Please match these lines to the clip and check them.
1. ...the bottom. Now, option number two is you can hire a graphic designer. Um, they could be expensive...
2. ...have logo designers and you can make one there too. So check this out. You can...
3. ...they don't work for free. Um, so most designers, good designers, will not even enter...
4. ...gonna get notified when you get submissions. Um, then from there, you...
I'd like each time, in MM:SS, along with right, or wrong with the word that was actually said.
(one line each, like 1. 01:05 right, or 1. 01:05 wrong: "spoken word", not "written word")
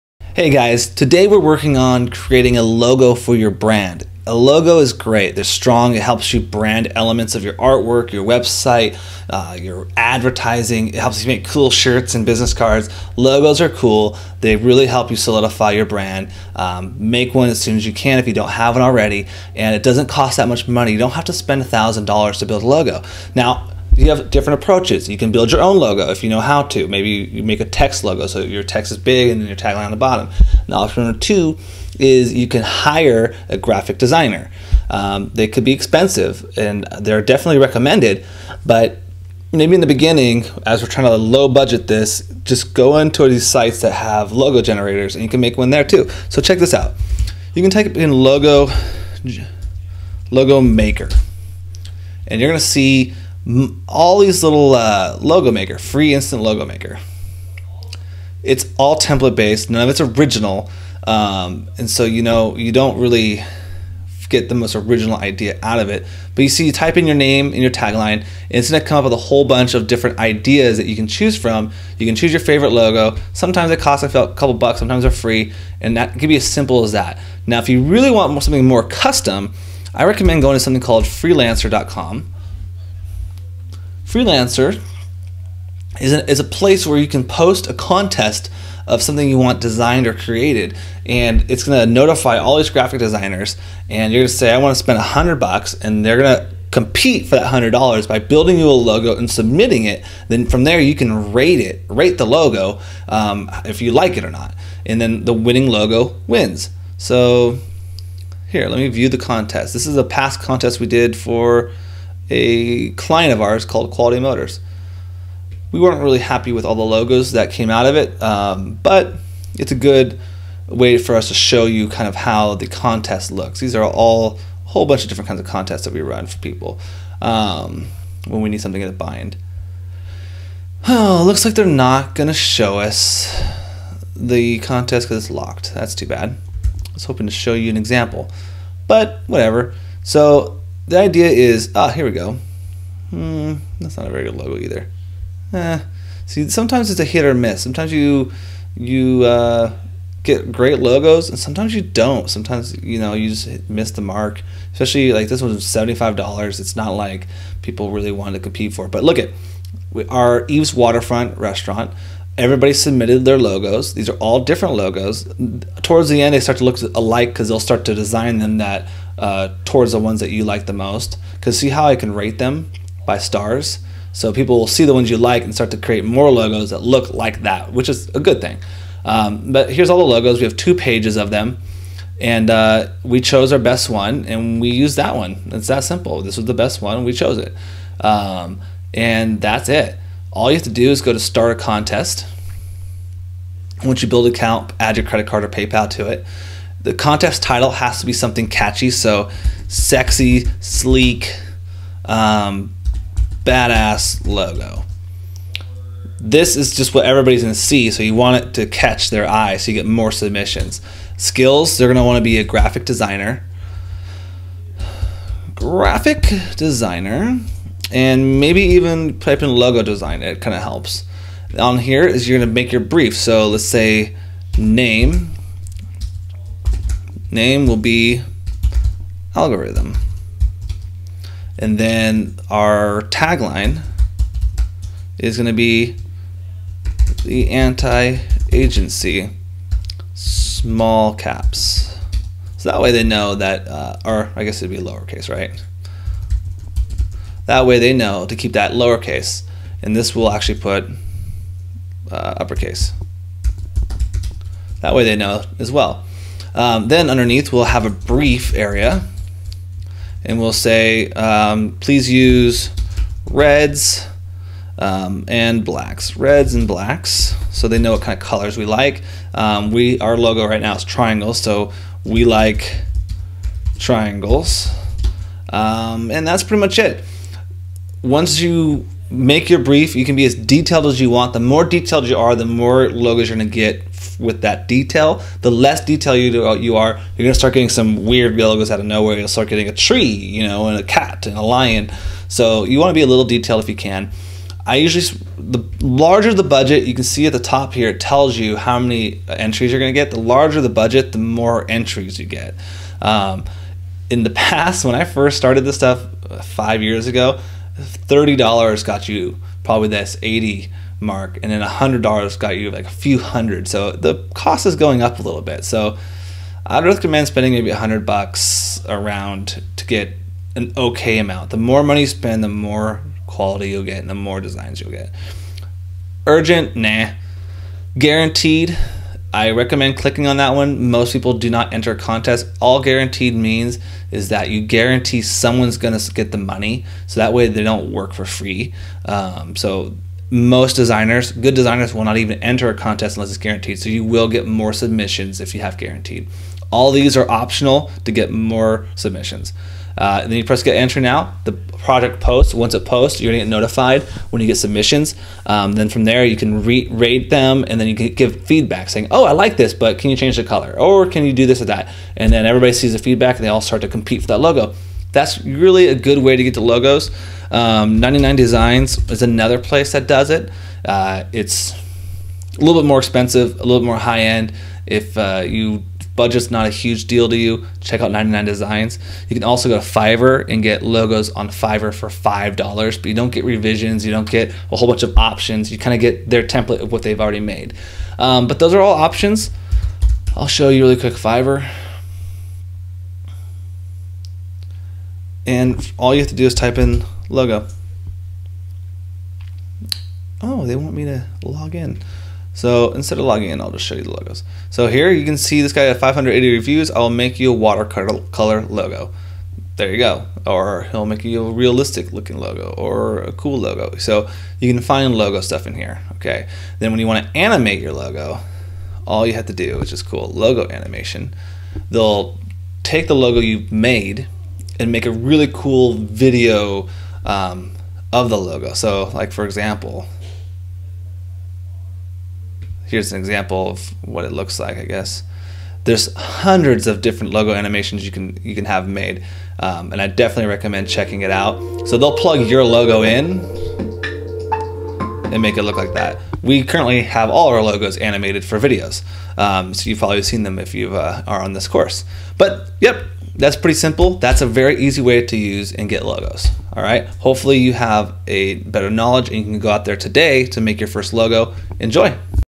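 1. 00:29 right
2. 00:43 wrong: "generators", not "designers"
3. 05:37 right
4. 05:53 right.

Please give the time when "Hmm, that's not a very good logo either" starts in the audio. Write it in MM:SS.
02:23.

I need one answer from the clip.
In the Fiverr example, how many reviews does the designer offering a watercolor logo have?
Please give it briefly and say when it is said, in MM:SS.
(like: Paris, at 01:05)
580, at 06:45.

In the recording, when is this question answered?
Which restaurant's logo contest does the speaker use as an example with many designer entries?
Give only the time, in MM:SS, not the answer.
02:40.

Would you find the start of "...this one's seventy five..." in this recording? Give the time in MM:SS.
02:35.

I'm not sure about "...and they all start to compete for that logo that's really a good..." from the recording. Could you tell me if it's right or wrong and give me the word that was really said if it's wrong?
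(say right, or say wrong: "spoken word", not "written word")
right.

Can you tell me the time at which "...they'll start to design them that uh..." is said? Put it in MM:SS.
02:47.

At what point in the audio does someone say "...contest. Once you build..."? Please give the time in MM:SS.
03:11.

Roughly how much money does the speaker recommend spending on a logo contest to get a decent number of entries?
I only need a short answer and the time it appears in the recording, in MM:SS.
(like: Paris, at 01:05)
$100, at 05:17.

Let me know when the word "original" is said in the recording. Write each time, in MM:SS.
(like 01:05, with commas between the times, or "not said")
01:00, 01:04.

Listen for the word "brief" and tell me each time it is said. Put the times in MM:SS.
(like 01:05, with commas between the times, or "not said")
03:42, 04:17, 04:39.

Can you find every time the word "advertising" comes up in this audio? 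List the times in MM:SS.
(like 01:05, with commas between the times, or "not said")
00:09.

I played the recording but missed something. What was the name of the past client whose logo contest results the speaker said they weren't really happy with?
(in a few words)
Quality Motors.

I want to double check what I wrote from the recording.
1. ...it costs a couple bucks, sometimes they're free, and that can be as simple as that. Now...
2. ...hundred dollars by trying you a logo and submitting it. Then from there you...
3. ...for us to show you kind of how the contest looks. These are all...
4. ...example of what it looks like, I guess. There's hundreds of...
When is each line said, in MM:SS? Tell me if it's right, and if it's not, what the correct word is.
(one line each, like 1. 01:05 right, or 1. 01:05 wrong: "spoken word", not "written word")
1. 01:13 right
2. 01:37 wrong: "building", not "trying"
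3. 02:00 right
4. 07:13 right.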